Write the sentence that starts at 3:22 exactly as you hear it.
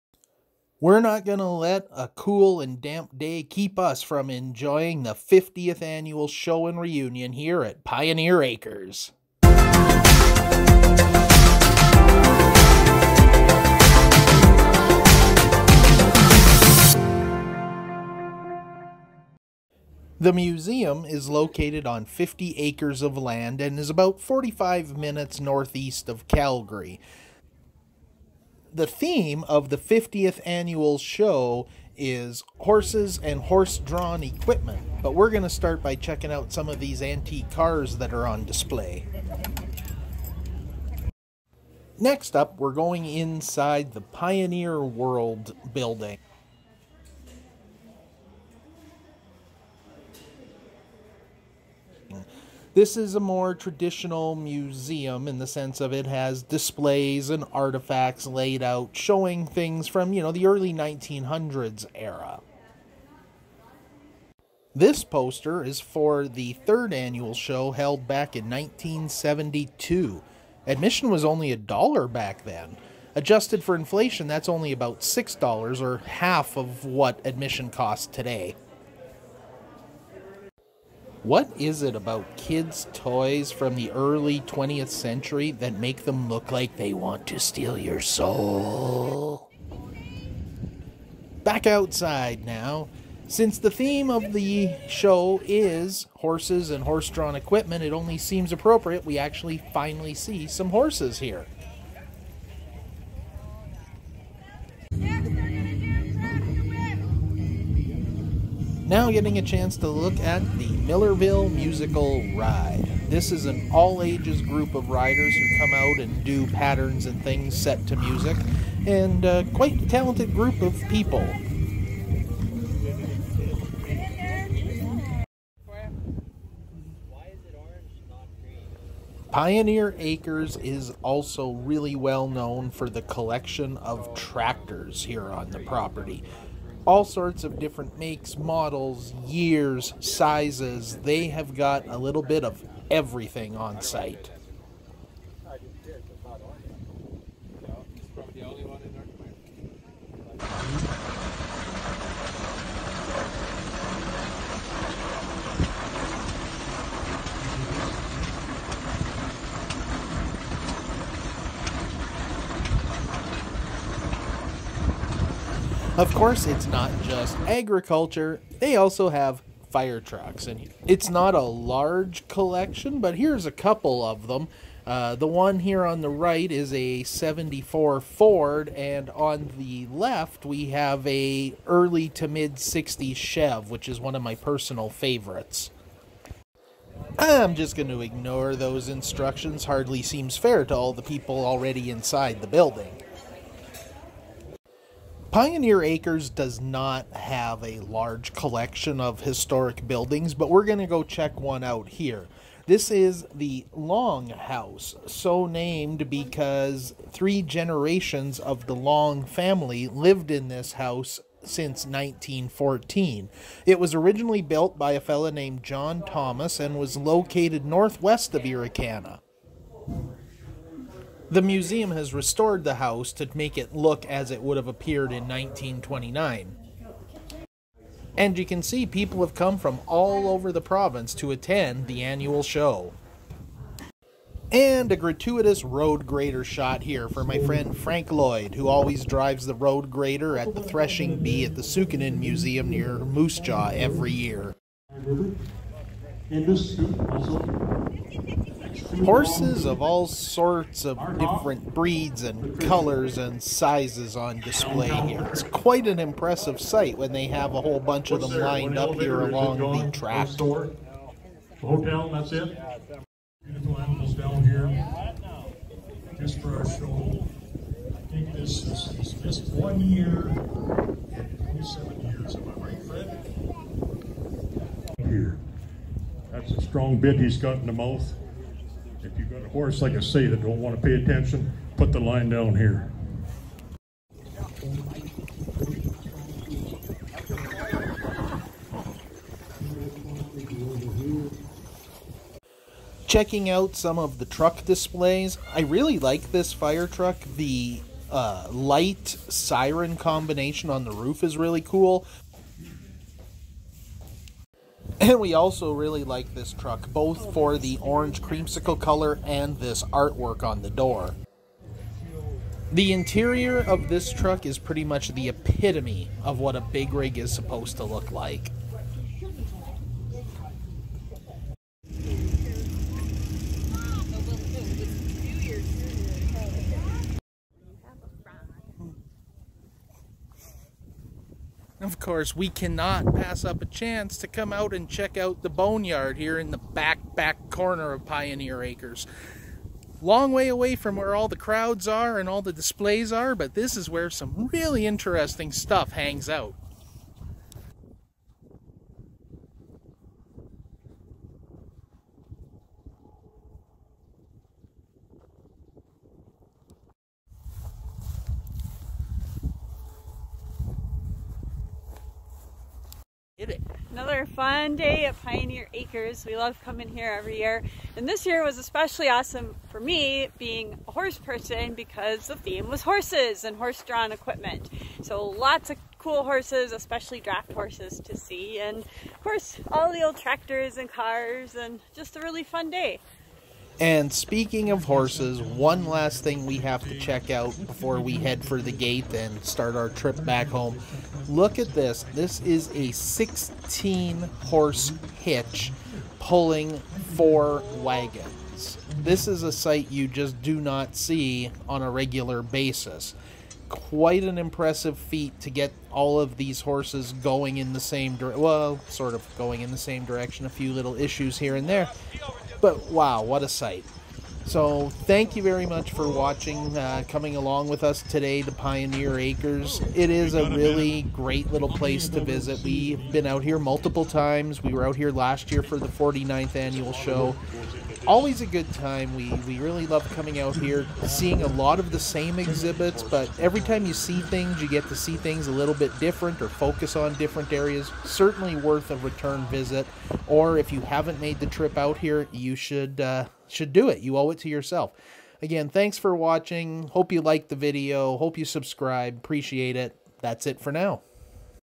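This is the Long House, so named because three generations of the Long family lived in this house since 1914.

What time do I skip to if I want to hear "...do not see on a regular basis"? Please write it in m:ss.
6:40.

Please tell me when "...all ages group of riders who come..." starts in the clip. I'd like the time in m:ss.
1:53.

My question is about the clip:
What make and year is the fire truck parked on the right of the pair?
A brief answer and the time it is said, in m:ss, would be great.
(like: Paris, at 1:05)
1974 Ford, at 2:57.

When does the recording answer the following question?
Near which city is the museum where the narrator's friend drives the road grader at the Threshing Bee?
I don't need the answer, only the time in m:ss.
4:02.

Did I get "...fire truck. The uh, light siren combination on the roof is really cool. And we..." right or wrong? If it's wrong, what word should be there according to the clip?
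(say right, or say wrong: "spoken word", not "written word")
right.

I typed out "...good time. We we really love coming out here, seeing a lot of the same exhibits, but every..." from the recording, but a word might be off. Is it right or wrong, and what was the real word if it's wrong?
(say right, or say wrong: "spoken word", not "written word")
right.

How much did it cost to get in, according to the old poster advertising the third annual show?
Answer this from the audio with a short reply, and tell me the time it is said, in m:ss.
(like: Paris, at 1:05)
$1, at 1:11.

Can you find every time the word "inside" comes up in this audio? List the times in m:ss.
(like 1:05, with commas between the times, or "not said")
0:43, 3:11.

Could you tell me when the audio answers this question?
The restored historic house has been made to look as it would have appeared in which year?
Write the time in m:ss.
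3:45.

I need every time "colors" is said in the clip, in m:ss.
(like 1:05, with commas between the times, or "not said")
4:12, 5:08.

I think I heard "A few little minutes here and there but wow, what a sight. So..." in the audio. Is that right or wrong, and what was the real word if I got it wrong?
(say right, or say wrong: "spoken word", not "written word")
wrong: "issues", not "minutes".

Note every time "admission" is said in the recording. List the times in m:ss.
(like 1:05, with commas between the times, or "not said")
1:10, 1:17.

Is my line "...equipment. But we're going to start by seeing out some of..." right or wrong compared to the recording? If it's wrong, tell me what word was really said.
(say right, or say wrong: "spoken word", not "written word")
wrong: "checking", not "seeing".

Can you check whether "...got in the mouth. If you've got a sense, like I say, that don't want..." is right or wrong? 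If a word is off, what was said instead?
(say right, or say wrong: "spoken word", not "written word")
wrong: "horse", not "sense".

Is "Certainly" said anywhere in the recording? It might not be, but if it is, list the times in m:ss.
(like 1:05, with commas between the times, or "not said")
7:18.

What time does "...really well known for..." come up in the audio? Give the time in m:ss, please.
2:11.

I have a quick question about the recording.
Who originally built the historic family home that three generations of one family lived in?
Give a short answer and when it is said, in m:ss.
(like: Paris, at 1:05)
John Thomas, at 3:35.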